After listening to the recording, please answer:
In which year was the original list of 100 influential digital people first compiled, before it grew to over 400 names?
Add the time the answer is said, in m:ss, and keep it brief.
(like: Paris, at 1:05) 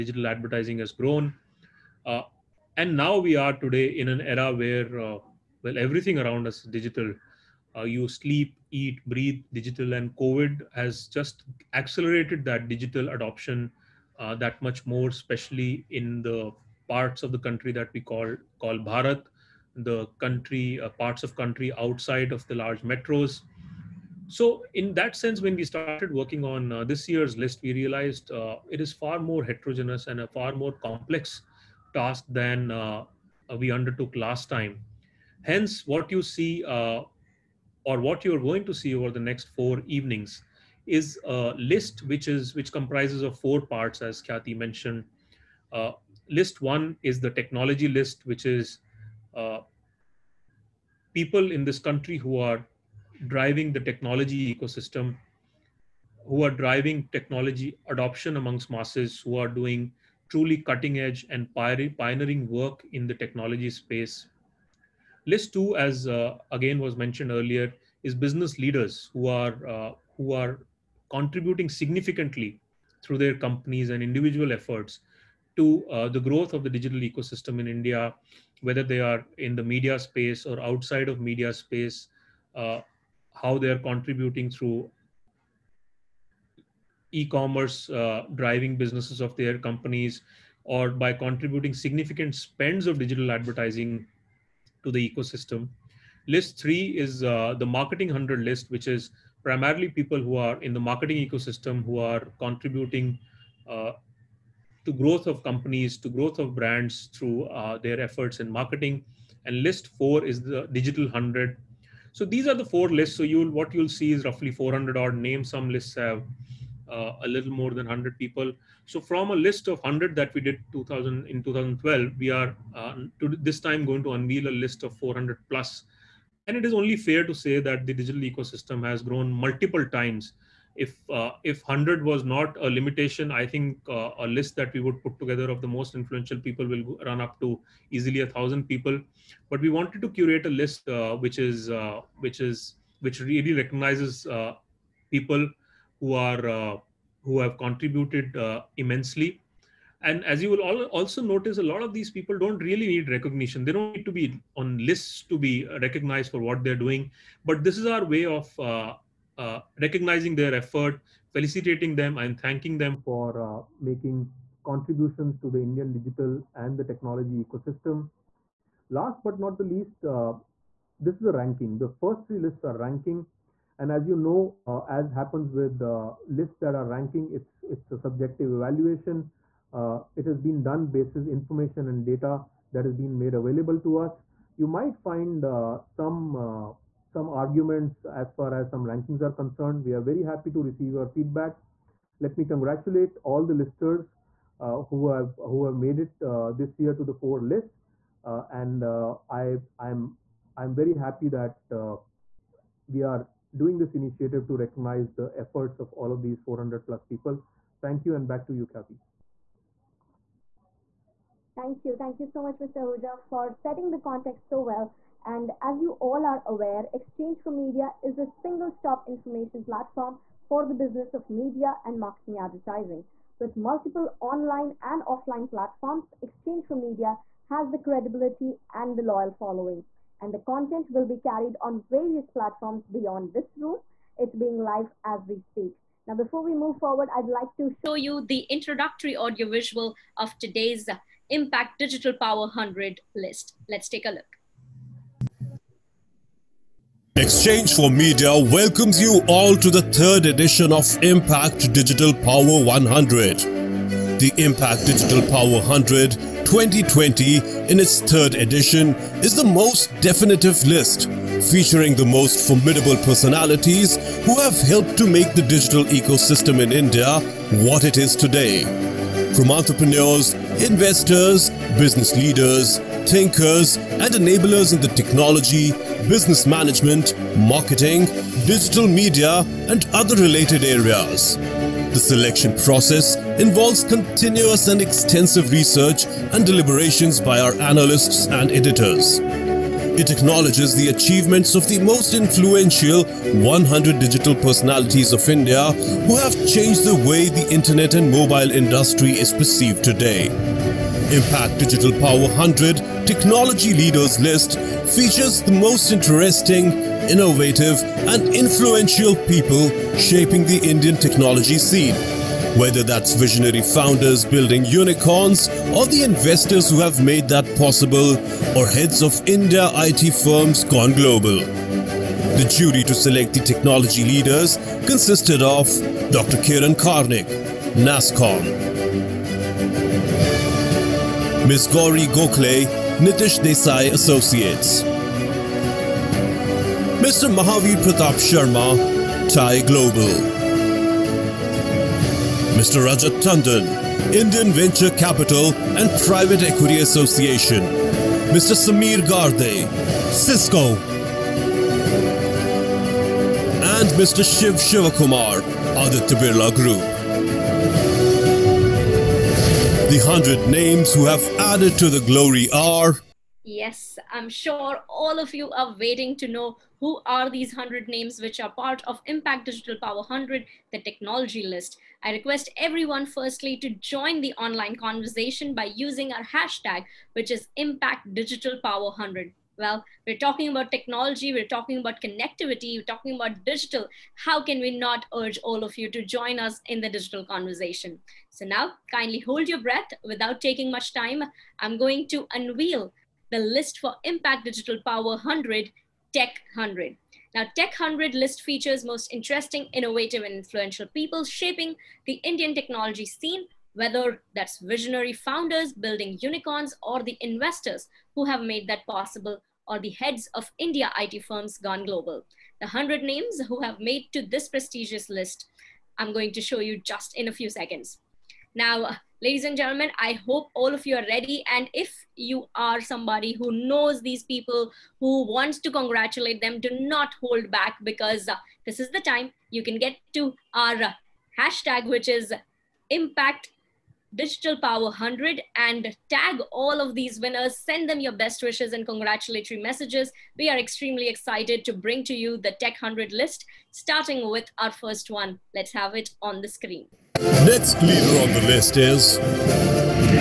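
2012, at 2:01.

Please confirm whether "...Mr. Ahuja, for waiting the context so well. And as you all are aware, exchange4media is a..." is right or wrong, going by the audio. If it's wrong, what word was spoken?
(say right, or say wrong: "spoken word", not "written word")
wrong: "setting", not "waiting".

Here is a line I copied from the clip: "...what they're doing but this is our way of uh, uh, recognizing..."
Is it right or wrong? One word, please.
right.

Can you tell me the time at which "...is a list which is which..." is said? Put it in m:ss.
0:40.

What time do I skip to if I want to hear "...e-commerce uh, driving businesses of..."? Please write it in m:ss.
1:27.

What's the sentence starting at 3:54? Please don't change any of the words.
It's being live as we speak.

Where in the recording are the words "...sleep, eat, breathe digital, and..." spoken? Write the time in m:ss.
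0:08.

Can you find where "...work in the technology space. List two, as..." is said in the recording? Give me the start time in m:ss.
1:02.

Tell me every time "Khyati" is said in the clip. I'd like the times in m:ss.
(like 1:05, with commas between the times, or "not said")
0:44, 3:28.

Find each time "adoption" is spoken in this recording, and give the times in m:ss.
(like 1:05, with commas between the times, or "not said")
0:13, 0:57.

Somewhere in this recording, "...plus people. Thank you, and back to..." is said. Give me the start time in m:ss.
3:26.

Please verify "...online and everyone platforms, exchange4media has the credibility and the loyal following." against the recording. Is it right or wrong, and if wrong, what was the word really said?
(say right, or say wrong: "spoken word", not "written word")
wrong: "offline", not "everyone".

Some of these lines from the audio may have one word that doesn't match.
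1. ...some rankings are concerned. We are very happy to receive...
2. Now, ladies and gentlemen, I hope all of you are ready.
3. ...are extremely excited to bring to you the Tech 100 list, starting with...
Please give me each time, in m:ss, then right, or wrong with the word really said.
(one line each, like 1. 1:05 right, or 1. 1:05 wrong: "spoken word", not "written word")
1. 3:08 right
2. 6:58 right
3. 7:20 right.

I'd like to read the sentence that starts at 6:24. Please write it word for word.
How can we not urge all of you to join us in the digital conversation?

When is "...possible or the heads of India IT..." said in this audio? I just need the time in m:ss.
6:48.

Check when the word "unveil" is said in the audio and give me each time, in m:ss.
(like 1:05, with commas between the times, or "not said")
2:04, 6:32.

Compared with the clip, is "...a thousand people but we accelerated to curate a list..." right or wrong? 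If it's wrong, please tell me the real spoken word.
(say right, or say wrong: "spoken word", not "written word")
wrong: "wanted", not "accelerated".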